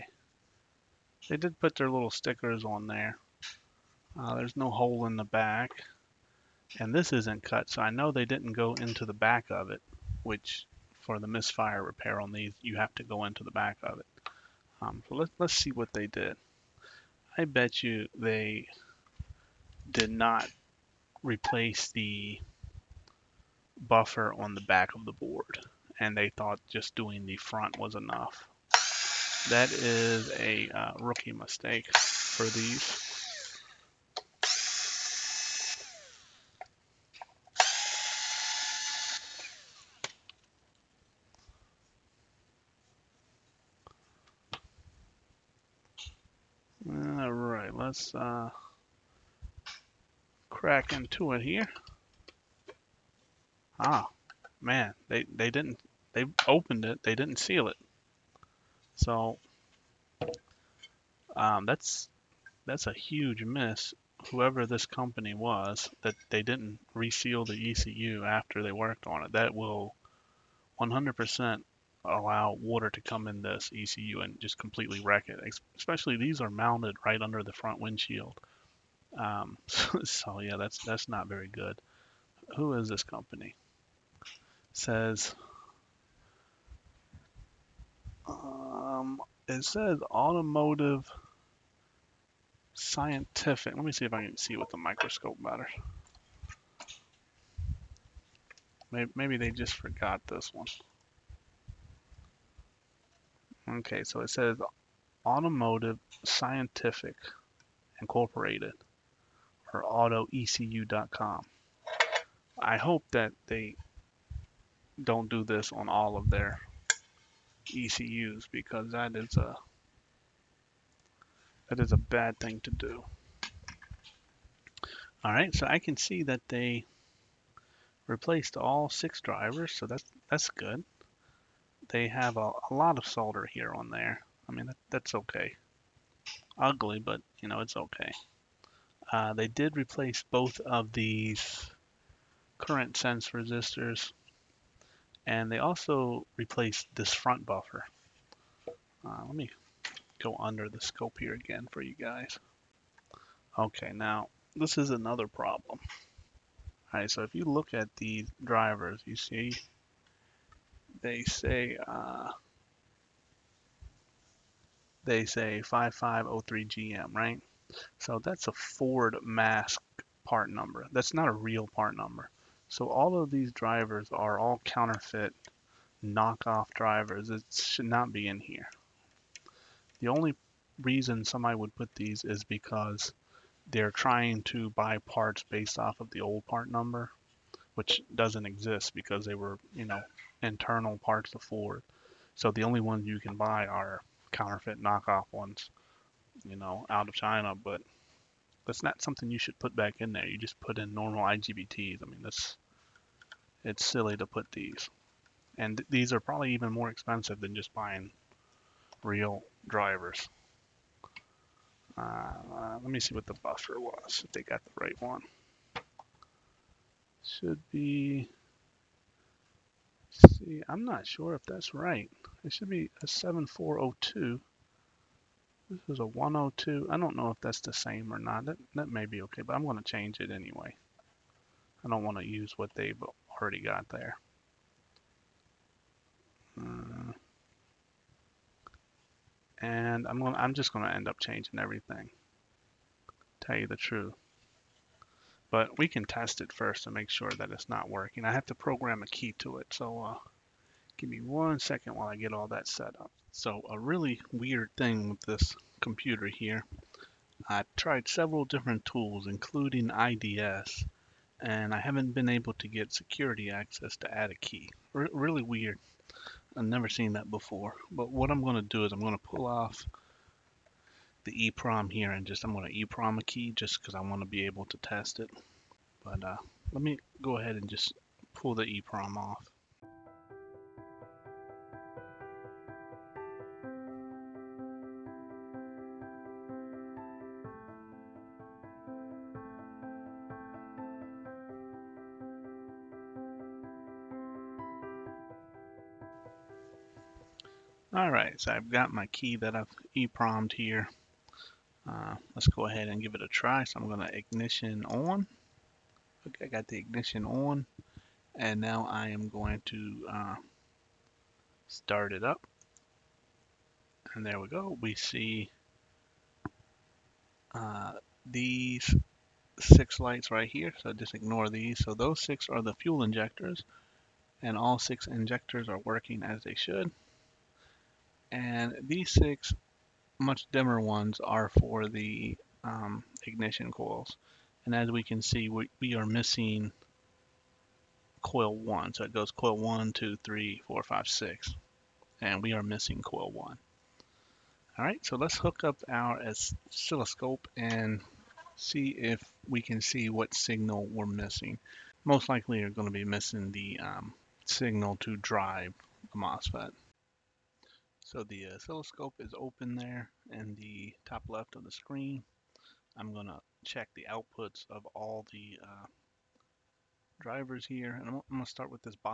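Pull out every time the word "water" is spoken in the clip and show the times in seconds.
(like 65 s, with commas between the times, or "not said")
72 s.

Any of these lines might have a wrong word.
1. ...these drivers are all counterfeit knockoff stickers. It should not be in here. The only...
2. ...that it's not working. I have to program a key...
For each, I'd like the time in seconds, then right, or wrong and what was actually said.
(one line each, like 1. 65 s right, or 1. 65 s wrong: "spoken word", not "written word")
1. 173 s wrong: "drivers", not "stickers"
2. 247 s right.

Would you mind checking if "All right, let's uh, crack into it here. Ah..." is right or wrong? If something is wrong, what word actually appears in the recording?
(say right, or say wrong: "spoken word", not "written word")
right.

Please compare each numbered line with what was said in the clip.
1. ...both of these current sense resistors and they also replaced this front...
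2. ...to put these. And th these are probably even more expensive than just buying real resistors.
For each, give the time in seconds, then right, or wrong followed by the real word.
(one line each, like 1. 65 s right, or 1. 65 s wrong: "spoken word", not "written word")
1. 140 s right
2. 204 s wrong: "drivers", not "resistors".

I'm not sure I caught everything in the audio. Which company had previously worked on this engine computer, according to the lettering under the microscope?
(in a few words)
Automotive Scientific Incorporated.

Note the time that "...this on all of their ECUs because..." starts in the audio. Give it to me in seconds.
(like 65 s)
115 s.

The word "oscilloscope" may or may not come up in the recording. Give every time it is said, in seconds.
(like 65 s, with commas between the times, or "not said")
346 s, 358 s.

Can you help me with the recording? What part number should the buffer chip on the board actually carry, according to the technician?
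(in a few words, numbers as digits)
7402.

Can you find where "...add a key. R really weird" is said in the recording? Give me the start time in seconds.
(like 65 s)
264 s.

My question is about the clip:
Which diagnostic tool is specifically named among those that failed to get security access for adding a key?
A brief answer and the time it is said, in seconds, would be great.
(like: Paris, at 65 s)
IDS, at 259 s.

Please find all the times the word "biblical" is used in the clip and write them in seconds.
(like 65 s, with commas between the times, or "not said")
not said.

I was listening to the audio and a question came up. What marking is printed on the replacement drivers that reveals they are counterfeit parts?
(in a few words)
5503 GM.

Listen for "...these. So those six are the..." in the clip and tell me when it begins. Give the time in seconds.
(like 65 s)
321 s.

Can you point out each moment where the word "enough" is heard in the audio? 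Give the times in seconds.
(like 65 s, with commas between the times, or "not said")
27 s.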